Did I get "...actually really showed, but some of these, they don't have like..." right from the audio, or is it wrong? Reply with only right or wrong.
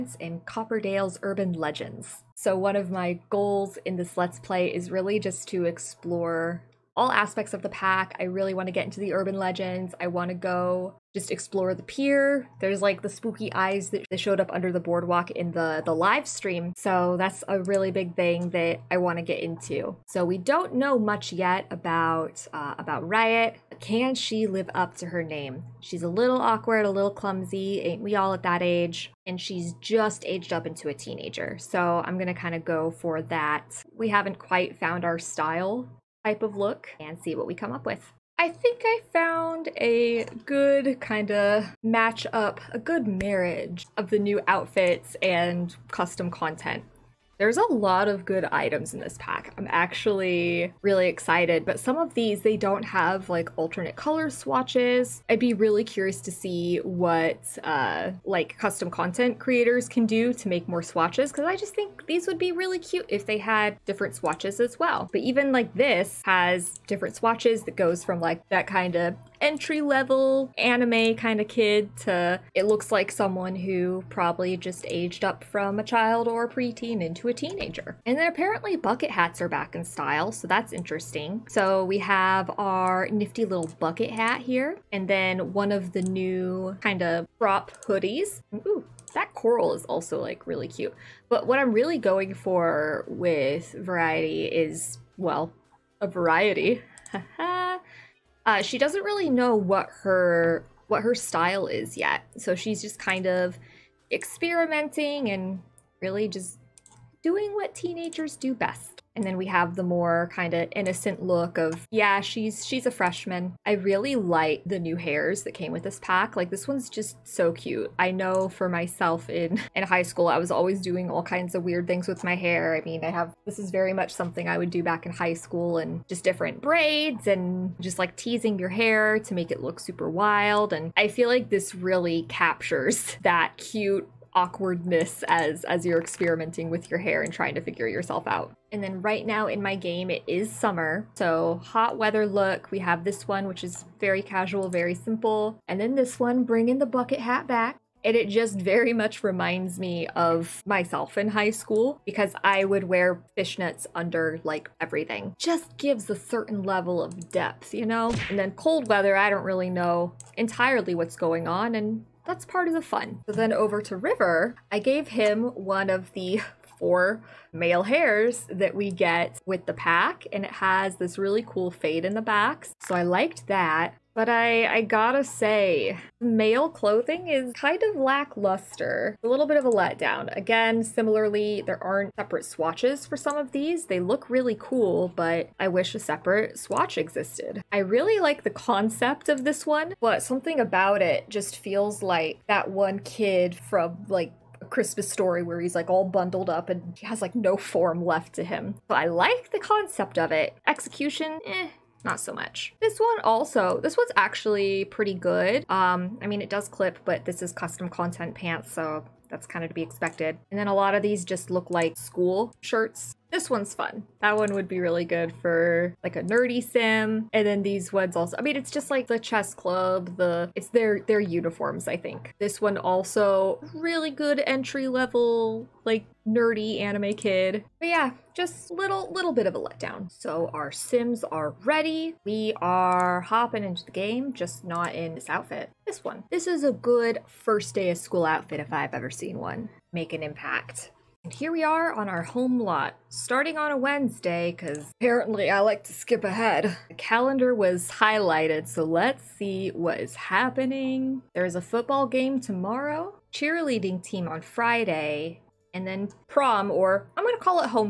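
wrong.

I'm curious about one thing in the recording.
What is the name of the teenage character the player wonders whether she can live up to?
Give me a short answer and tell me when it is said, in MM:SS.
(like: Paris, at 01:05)
Riot, at 00:23.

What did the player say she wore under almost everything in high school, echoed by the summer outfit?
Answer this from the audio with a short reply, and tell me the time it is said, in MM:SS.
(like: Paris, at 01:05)
Fishnets, at 02:33.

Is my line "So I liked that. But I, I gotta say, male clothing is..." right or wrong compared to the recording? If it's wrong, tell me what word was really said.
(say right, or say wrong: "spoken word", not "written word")
right.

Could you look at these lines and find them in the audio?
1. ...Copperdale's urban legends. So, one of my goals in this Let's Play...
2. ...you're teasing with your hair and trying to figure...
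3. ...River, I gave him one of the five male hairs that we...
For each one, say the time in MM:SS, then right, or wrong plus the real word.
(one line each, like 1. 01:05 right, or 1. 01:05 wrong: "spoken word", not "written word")
1. 00:00 right
2. 02:15 wrong: "experimenting", not "teasing"
3. 02:43 wrong: "four", not "five".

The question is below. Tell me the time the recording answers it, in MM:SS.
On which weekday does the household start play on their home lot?
04:03.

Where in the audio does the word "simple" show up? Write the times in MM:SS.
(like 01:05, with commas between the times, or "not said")
02:24.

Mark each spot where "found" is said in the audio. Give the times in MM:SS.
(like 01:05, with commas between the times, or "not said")
00:34, 00:39.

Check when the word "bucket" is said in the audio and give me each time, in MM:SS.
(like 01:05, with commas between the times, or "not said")
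01:18, 01:23, 02:26.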